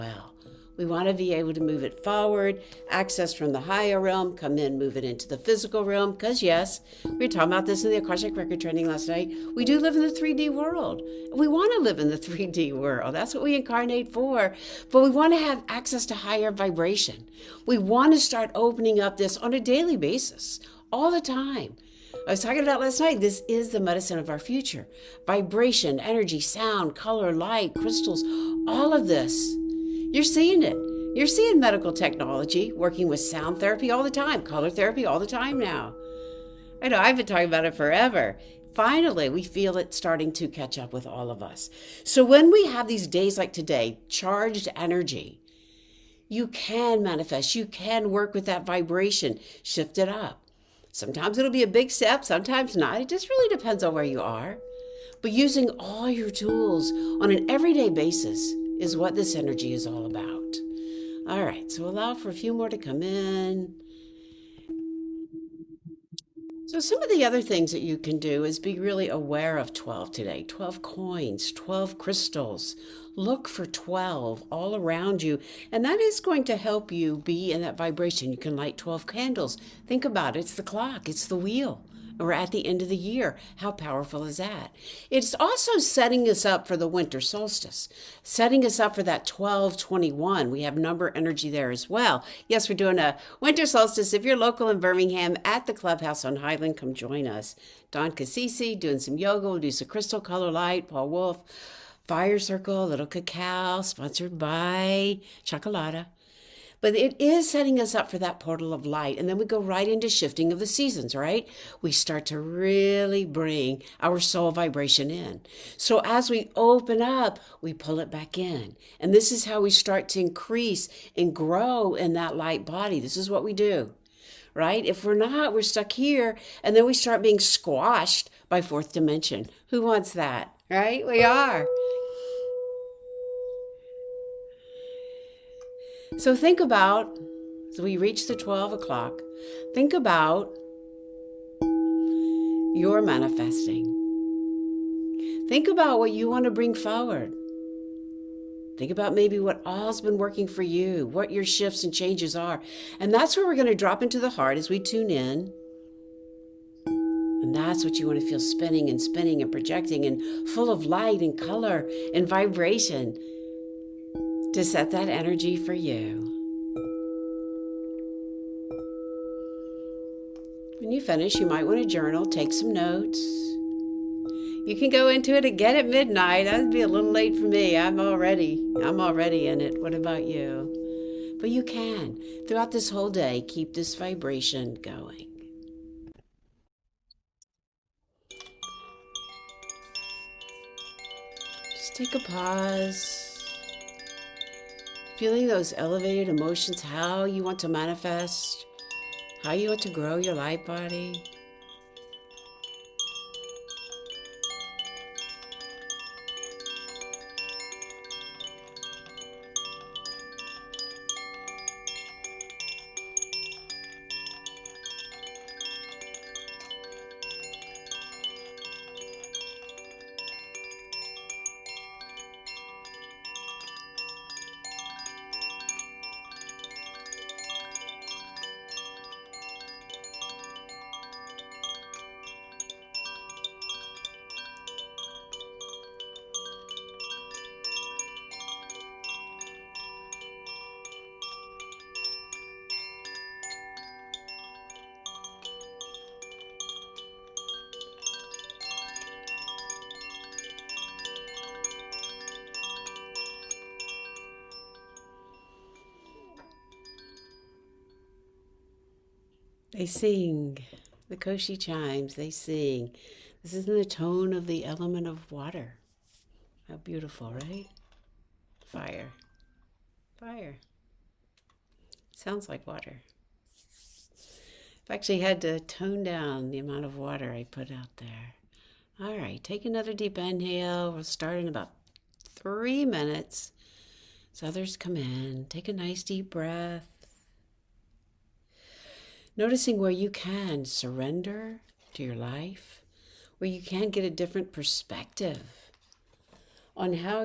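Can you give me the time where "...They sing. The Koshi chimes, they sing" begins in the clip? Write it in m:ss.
4:19.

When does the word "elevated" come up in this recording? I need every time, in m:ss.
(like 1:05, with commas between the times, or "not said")
3:15.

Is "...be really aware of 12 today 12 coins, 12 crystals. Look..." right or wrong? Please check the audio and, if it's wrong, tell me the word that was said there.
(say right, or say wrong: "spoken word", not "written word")
right.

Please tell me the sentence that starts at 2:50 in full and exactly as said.
When you finish, you might want to journal, take some notes.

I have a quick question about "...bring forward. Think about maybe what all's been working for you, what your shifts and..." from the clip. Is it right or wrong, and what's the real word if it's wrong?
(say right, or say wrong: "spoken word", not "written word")
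right.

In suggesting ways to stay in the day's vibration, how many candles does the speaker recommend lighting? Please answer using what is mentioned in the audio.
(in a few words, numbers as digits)
12.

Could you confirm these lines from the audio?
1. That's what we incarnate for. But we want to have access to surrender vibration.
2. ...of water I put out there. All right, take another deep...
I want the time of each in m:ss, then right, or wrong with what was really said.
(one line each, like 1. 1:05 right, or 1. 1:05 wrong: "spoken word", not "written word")
1. 0:13 wrong: "higher", not "surrender"
2. 4:36 right.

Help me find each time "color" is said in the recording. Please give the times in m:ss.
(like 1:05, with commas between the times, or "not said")
0:26, 0:34, 1:40, 2:41.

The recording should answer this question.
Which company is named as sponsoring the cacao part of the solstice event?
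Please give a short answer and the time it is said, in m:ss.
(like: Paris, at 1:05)
Chocolata, at 1:45.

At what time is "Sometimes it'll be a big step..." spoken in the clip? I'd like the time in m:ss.
0:50.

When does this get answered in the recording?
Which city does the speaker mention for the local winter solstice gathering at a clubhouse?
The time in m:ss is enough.
1:34.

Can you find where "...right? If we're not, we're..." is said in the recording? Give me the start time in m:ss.
2:04.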